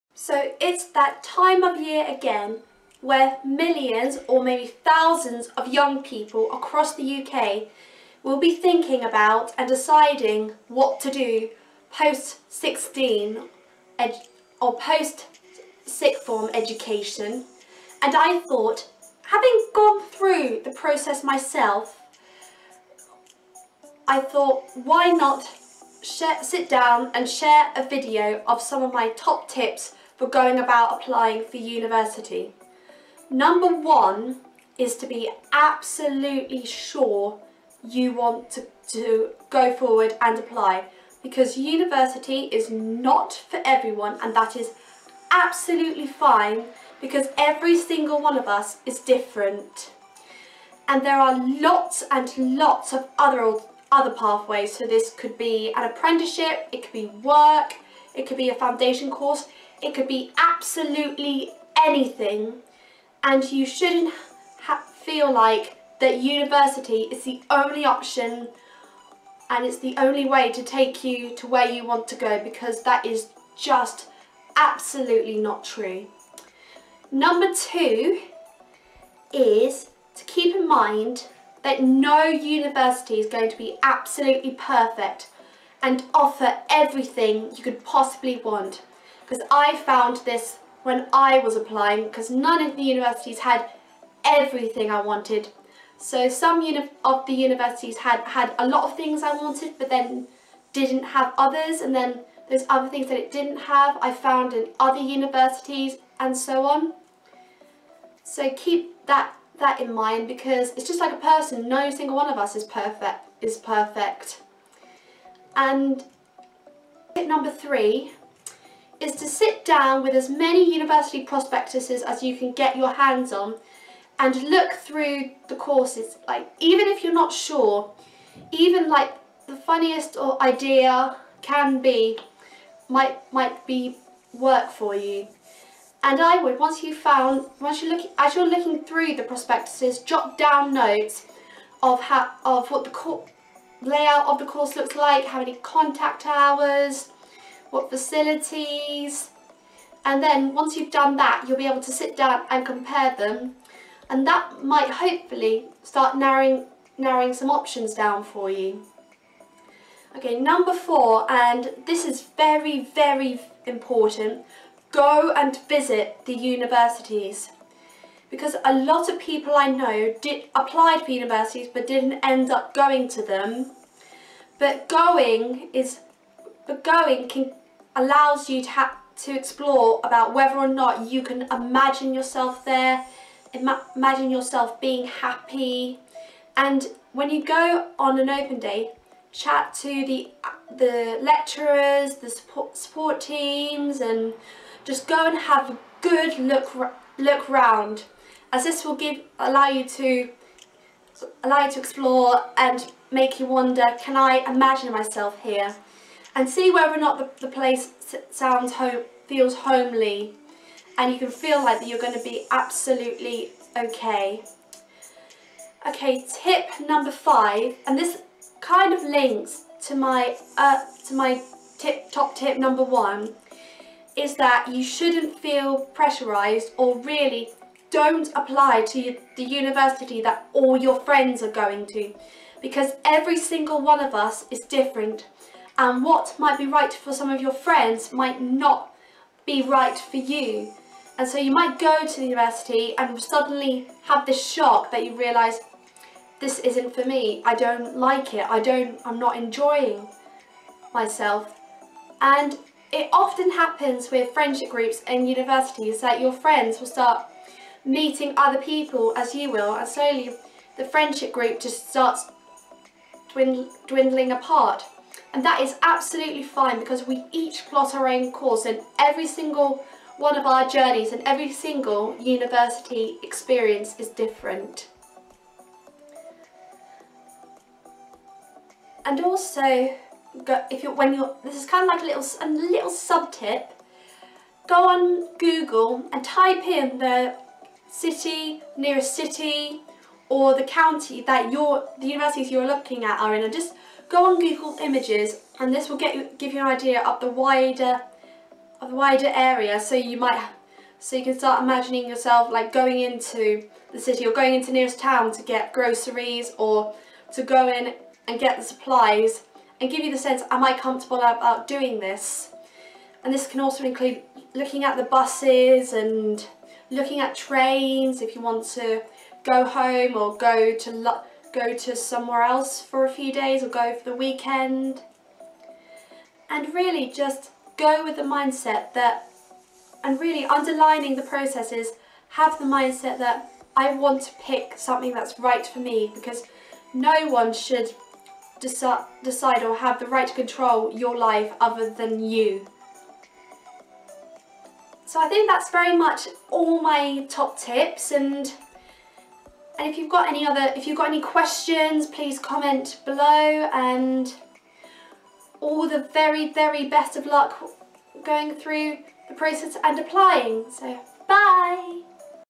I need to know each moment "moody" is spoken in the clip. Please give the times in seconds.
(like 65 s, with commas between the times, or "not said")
not said.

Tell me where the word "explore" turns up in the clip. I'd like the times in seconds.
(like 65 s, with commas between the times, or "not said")
179 s, 201 s.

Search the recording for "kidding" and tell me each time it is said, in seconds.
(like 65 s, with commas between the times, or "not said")
not said.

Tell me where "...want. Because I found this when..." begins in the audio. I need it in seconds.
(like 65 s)
88 s.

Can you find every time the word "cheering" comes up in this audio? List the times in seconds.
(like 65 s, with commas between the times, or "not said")
not said.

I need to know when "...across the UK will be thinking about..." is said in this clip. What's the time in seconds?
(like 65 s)
6 s.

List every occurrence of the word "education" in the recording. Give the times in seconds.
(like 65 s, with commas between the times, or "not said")
16 s.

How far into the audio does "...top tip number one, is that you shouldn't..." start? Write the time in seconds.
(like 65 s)
222 s.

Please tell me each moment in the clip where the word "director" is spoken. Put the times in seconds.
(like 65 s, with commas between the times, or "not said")
not said.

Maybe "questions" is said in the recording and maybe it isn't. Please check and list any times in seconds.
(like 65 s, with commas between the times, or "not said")
351 s.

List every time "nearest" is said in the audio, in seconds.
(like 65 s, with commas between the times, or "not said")
288 s, 304 s.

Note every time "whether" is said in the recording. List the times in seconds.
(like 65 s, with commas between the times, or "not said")
180 s, 206 s.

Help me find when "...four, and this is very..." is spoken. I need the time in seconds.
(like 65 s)
160 s.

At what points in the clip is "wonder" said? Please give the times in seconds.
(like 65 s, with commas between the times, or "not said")
203 s.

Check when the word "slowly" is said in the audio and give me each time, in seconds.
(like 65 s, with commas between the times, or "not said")
259 s.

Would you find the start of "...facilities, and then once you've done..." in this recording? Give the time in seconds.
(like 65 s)
147 s.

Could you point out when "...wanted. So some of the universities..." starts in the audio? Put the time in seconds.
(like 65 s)
94 s.